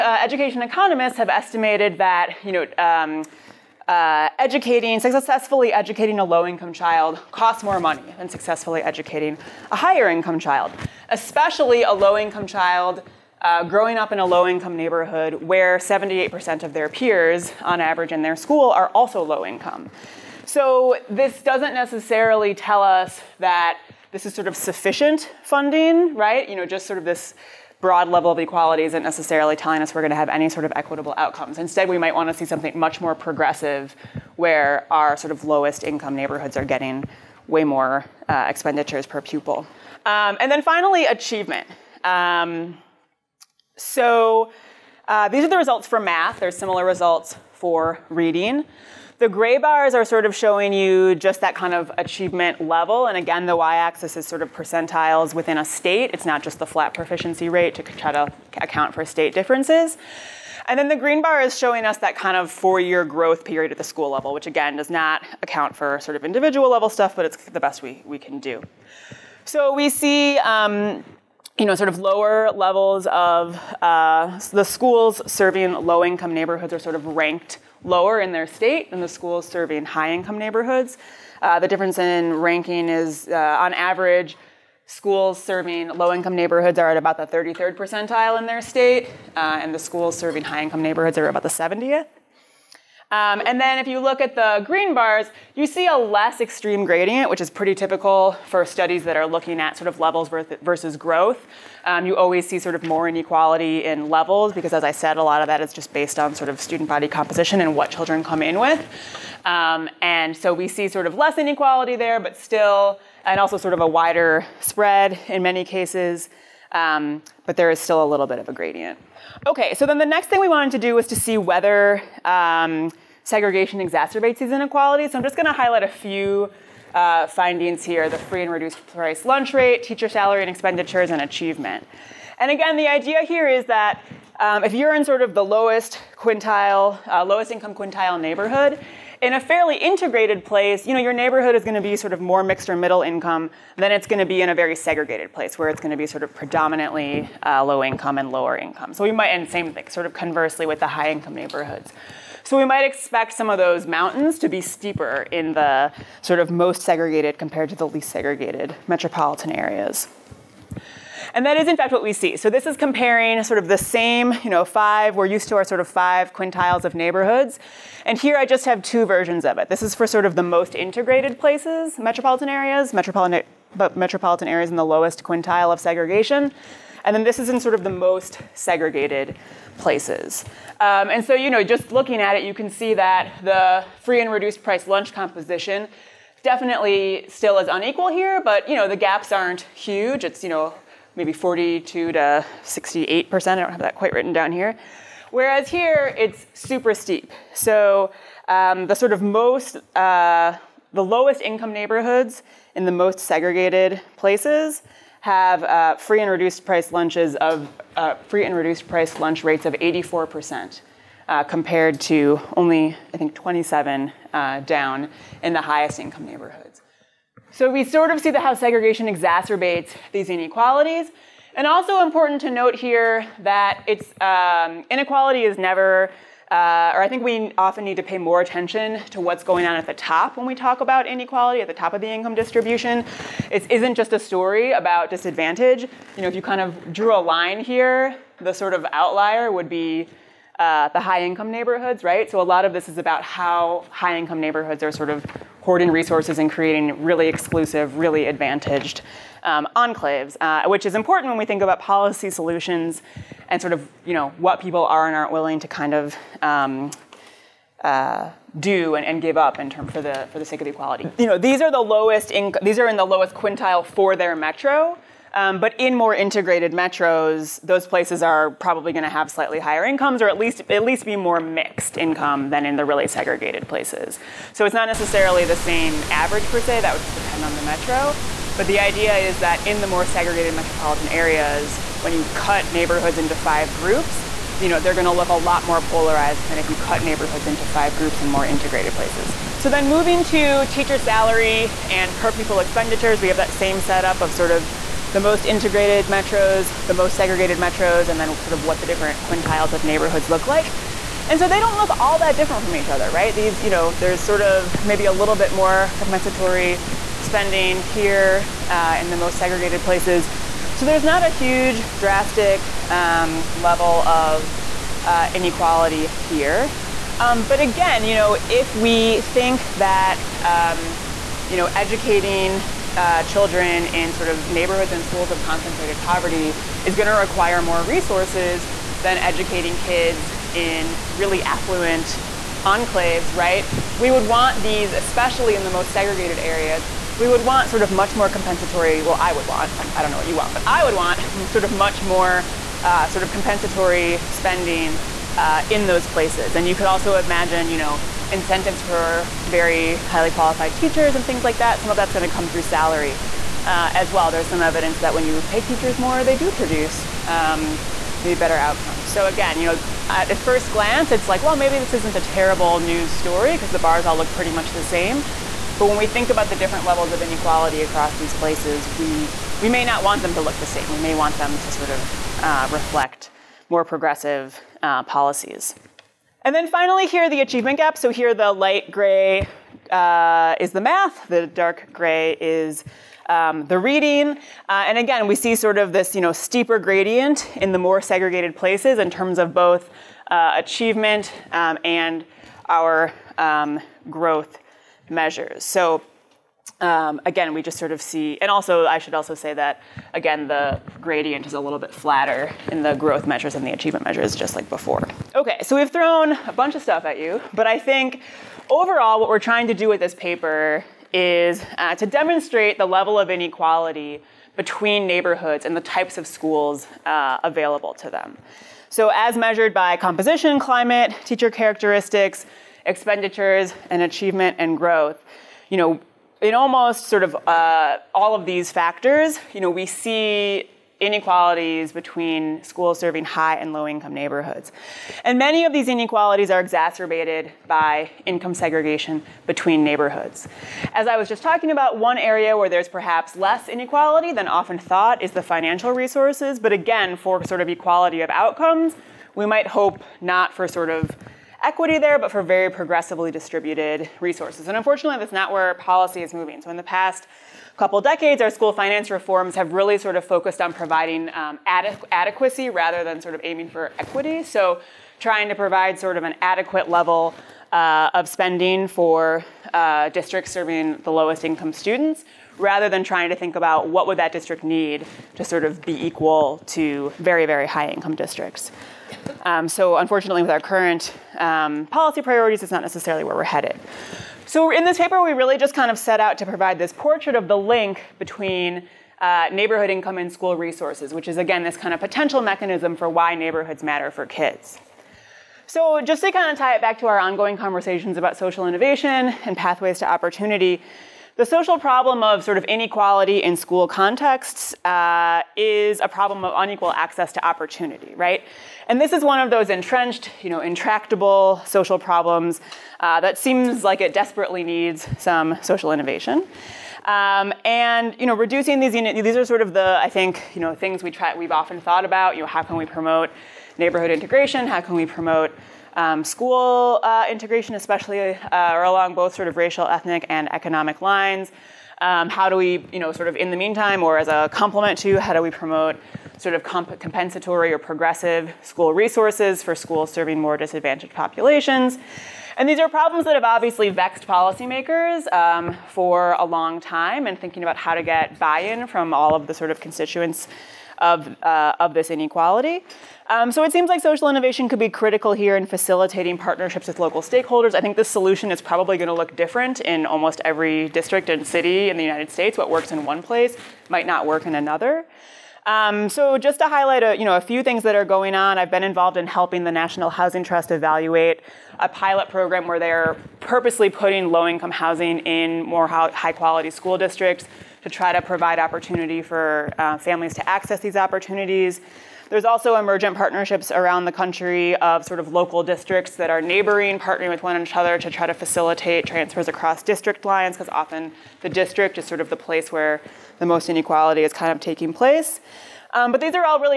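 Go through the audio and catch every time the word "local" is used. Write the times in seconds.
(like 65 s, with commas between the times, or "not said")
557 s, 585 s.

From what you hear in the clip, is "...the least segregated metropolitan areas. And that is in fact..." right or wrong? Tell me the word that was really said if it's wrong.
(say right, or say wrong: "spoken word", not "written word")
right.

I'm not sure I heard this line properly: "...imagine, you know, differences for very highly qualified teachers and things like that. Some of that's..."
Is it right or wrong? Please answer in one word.
wrong.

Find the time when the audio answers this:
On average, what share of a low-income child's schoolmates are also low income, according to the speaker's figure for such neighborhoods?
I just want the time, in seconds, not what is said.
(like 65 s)
15 s.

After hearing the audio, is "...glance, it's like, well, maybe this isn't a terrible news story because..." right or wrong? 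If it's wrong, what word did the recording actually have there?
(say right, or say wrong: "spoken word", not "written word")
right.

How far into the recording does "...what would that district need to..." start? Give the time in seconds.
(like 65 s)
473 s.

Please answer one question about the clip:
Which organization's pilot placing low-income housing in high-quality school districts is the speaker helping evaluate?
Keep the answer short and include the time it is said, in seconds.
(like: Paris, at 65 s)
National Housing Trust, at 569 s.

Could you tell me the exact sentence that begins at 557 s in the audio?
I think the solution is probably going to look different in almost every district and city in the United States.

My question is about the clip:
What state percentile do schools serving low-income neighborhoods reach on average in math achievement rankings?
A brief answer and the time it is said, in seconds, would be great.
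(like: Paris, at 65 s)
33rd, at 87 s.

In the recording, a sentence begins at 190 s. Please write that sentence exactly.
It's, you know, maybe 42 to 68 percent.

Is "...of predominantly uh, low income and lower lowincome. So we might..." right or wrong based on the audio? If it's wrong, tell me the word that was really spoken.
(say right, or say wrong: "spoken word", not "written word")
wrong: "income", not "lowincome".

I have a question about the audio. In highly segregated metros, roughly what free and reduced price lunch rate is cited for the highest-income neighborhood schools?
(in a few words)
27%.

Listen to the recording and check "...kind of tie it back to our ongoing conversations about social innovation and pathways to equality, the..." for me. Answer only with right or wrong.
wrong.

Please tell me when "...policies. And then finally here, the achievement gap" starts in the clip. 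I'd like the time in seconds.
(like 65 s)
375 s.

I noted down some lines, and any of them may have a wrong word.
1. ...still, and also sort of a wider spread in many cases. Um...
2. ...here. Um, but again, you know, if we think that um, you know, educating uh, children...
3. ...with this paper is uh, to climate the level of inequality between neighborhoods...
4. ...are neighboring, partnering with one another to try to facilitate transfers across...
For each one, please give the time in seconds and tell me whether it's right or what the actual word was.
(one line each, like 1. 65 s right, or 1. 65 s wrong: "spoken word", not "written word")
1. 112 s right
2. 316 s right
3. 409 s wrong: "demonstrate", not "climate"
4. 586 s right.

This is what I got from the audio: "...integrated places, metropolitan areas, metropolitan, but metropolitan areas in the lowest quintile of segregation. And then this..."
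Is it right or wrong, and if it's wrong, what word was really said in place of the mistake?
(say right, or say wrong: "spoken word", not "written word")
right.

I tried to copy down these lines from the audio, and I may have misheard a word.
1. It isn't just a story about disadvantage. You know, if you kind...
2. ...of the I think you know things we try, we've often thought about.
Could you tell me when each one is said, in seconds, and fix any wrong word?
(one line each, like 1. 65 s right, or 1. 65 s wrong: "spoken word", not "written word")
1. 233 s right
2. 519 s right.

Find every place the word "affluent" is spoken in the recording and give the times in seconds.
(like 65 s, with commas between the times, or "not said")
331 s.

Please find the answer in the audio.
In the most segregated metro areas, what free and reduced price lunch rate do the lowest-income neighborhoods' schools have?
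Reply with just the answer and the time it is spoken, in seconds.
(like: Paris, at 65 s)
84%, at 209 s.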